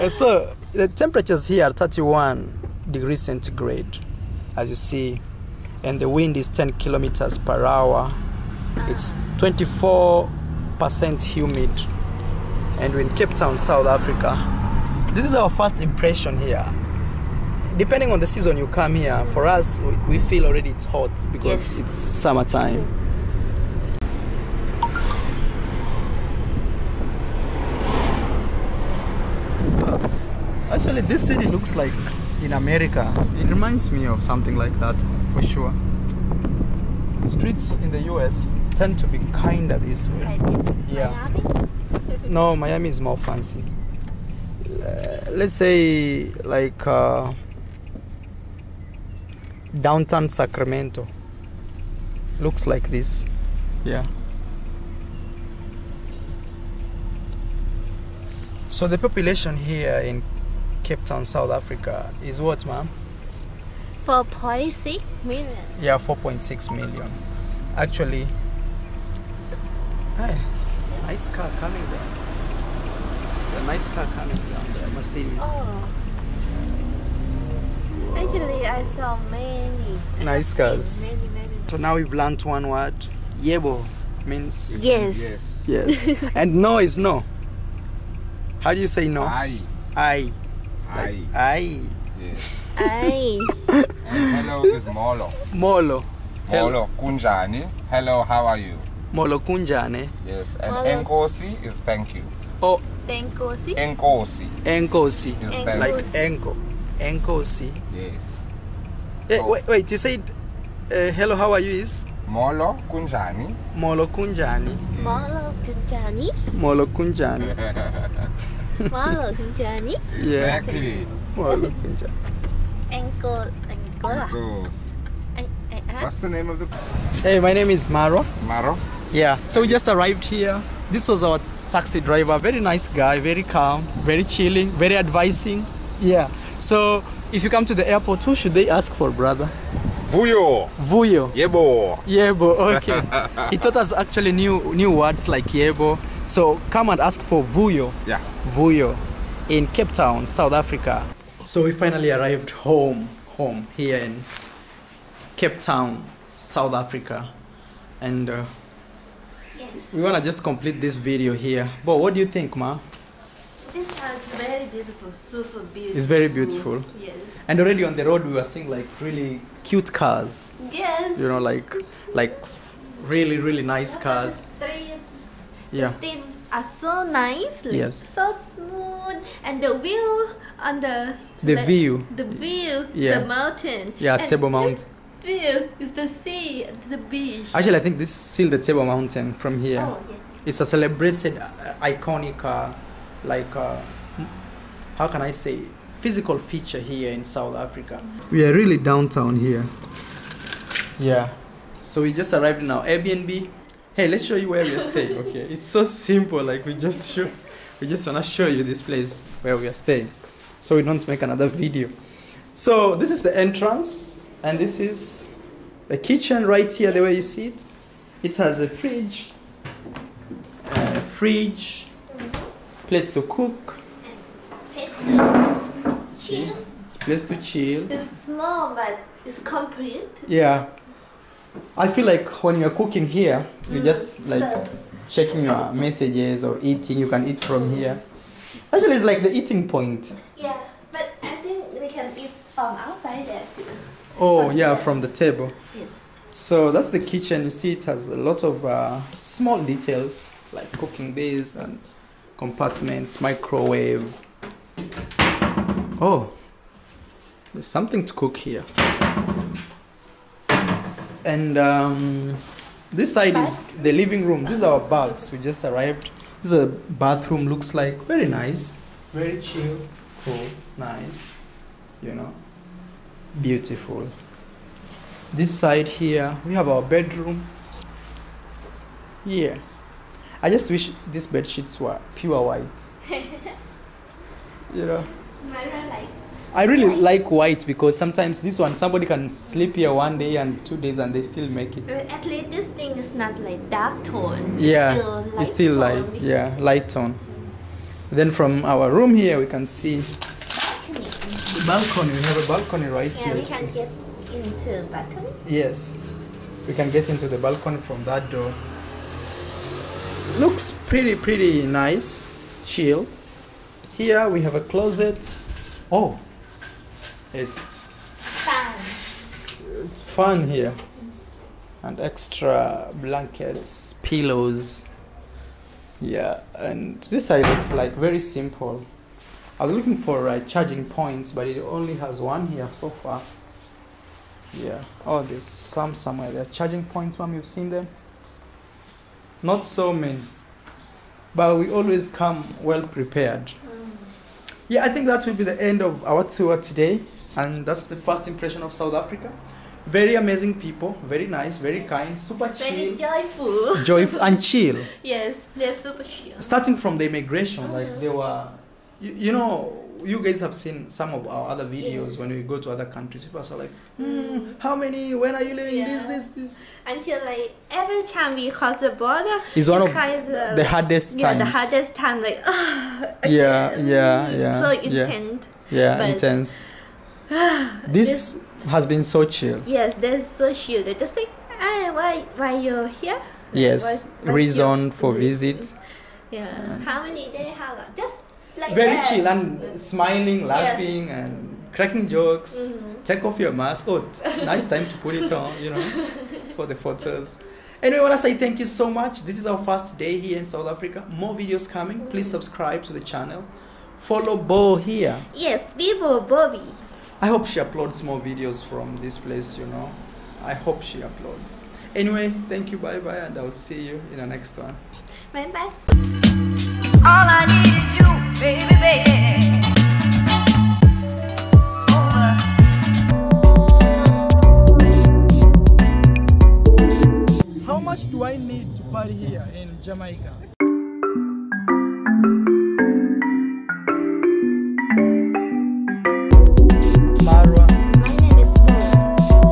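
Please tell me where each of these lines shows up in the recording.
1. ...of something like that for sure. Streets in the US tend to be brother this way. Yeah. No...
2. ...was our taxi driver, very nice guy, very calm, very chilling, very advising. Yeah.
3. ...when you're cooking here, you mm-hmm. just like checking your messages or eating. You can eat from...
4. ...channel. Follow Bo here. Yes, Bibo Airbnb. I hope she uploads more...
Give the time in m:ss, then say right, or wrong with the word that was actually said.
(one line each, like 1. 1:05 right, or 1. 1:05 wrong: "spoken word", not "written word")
1. 0:34 wrong: "kinder", not "brother"
2. 2:11 right
3. 3:52 right
4. 6:42 wrong: "Bobby", not "Airbnb".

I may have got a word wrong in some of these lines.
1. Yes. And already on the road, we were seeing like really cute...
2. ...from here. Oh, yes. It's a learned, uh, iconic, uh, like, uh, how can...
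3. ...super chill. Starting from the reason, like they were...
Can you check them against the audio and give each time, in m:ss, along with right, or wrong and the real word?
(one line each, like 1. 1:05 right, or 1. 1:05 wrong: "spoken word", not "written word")
1. 2:46 right
2. 3:09 wrong: "celebrated", not "learned"
3. 5:55 wrong: "immigration", not "reason".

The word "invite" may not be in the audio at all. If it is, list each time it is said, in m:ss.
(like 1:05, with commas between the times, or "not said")
not said.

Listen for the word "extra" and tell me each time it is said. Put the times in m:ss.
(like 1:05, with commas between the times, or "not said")
5:21.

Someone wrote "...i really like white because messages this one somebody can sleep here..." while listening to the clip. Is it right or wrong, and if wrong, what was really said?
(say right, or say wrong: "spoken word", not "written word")
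wrong: "sometimes", not "messages".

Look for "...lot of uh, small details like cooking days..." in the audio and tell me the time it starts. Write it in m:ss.
4:08.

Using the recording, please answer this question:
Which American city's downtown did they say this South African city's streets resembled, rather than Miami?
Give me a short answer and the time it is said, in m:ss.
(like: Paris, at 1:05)
Sacramento, at 0:50.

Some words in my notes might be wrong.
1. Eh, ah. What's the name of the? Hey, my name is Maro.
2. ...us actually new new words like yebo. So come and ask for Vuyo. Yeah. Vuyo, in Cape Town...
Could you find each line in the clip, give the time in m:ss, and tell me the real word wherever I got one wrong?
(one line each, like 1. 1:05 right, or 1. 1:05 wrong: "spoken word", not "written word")
1. 2:05 right
2. 2:23 right.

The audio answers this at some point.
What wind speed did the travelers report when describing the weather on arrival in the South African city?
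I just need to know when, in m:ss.
0:06.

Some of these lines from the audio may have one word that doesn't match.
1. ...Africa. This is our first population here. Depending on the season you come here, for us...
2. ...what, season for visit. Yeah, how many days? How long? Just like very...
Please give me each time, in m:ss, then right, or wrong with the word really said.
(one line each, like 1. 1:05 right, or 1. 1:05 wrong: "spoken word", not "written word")
1. 0:13 wrong: "impression", not "population"
2. 6:24 wrong: "reason", not "season".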